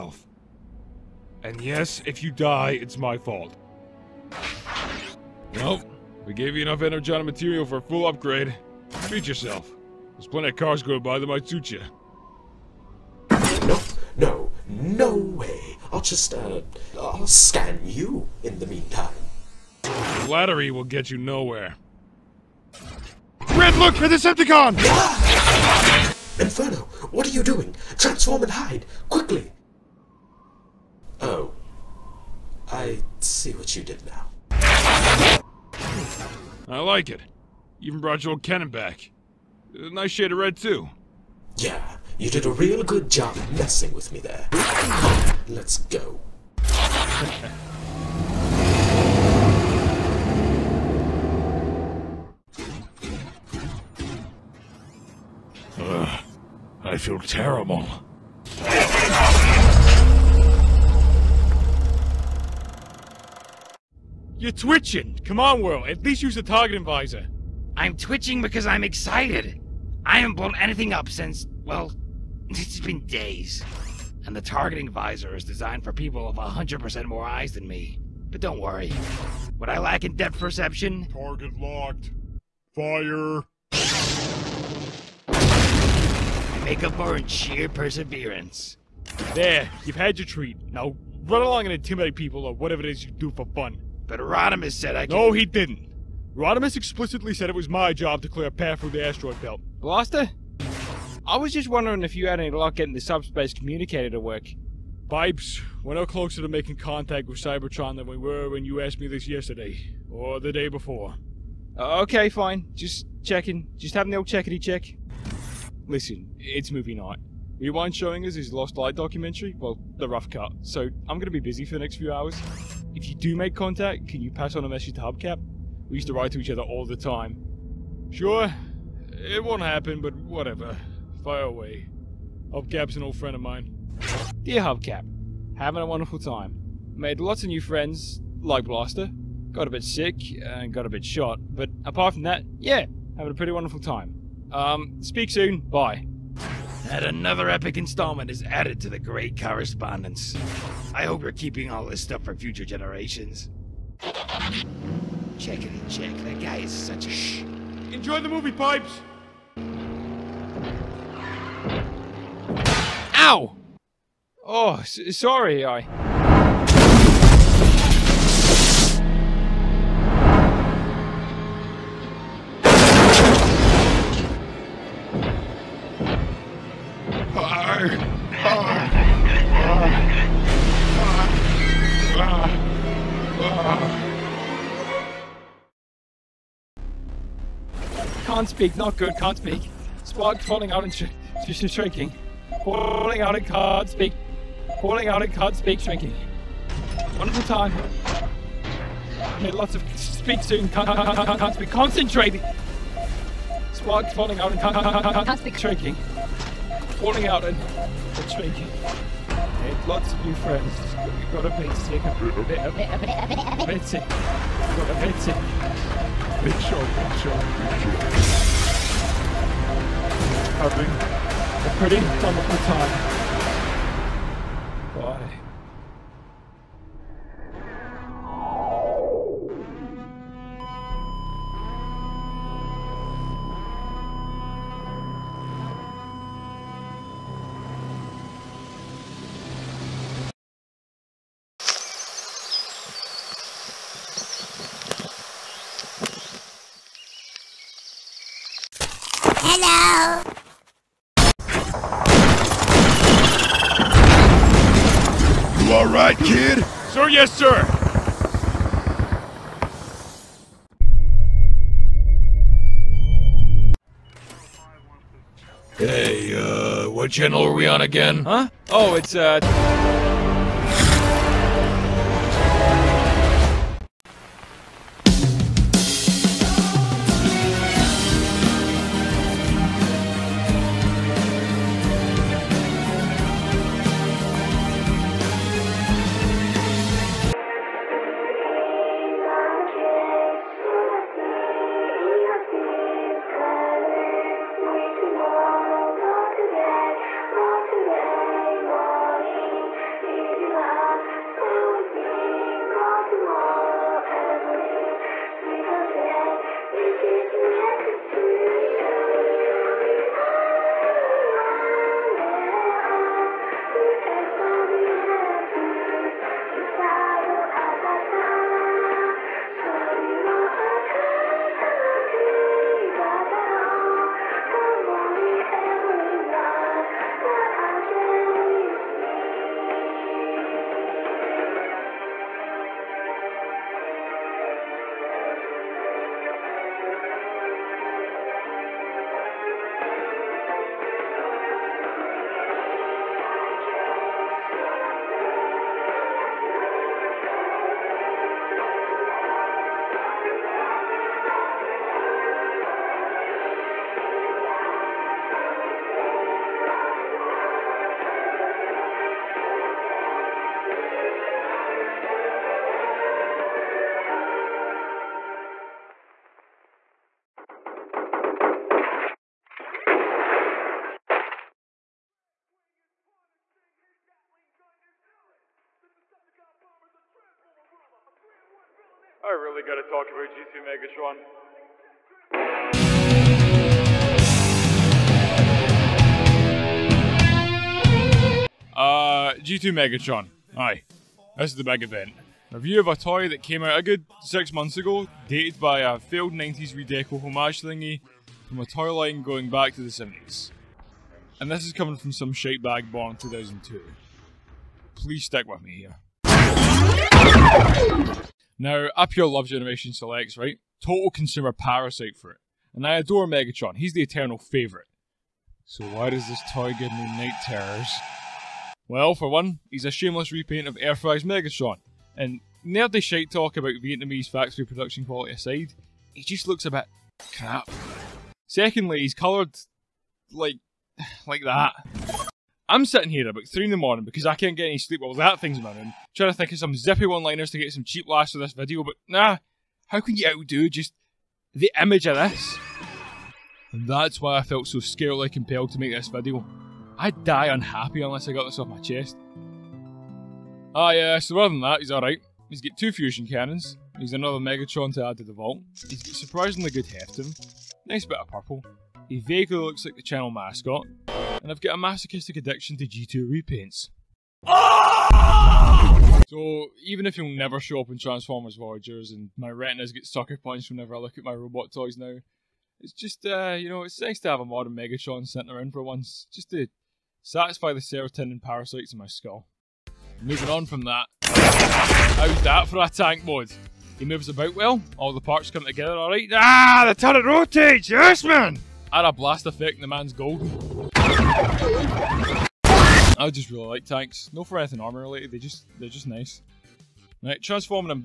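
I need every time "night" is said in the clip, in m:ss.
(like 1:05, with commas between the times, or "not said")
1:56, 6:57.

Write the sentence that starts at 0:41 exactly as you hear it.
Yeah, you did a real good job messing with me there.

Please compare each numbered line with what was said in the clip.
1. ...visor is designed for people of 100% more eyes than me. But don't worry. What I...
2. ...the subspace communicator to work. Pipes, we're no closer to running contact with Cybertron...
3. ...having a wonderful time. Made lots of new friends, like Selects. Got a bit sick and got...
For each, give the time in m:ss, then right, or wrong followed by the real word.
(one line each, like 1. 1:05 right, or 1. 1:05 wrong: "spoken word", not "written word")
1. 1:14 right
2. 1:42 wrong: "making", not "running"
3. 2:15 wrong: "Blaster", not "Selects".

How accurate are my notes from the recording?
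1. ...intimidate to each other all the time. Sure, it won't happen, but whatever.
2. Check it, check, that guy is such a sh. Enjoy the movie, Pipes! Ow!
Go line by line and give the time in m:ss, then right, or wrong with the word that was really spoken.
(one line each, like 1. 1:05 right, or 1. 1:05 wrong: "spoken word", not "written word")
1. 2:06 wrong: "write", not "intimidate"
2. 2:35 right.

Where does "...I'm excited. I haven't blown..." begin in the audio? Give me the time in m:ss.
1:08.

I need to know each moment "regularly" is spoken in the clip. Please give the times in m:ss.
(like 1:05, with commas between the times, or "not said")
not said.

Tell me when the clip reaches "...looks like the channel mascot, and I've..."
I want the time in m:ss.
7:39.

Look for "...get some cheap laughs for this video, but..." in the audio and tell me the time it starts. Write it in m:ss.
7:17.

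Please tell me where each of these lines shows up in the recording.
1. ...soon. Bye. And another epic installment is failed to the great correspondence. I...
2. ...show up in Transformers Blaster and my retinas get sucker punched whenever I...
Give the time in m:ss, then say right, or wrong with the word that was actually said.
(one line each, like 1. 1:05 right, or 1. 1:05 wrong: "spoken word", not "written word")
1. 2:25 wrong: "added", not "failed"
2. 7:47 wrong: "Voyagers", not "Blaster".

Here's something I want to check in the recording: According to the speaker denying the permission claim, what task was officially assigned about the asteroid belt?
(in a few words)
clear a path.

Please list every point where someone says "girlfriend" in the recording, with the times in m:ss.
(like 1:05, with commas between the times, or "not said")
not said.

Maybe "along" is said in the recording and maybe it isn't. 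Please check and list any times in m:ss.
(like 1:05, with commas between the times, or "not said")
1:31.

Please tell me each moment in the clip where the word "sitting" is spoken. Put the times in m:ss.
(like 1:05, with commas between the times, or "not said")
7:12, 7:55.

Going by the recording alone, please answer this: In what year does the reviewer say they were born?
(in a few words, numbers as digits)
2002.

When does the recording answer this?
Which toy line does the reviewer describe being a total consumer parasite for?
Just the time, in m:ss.
6:49.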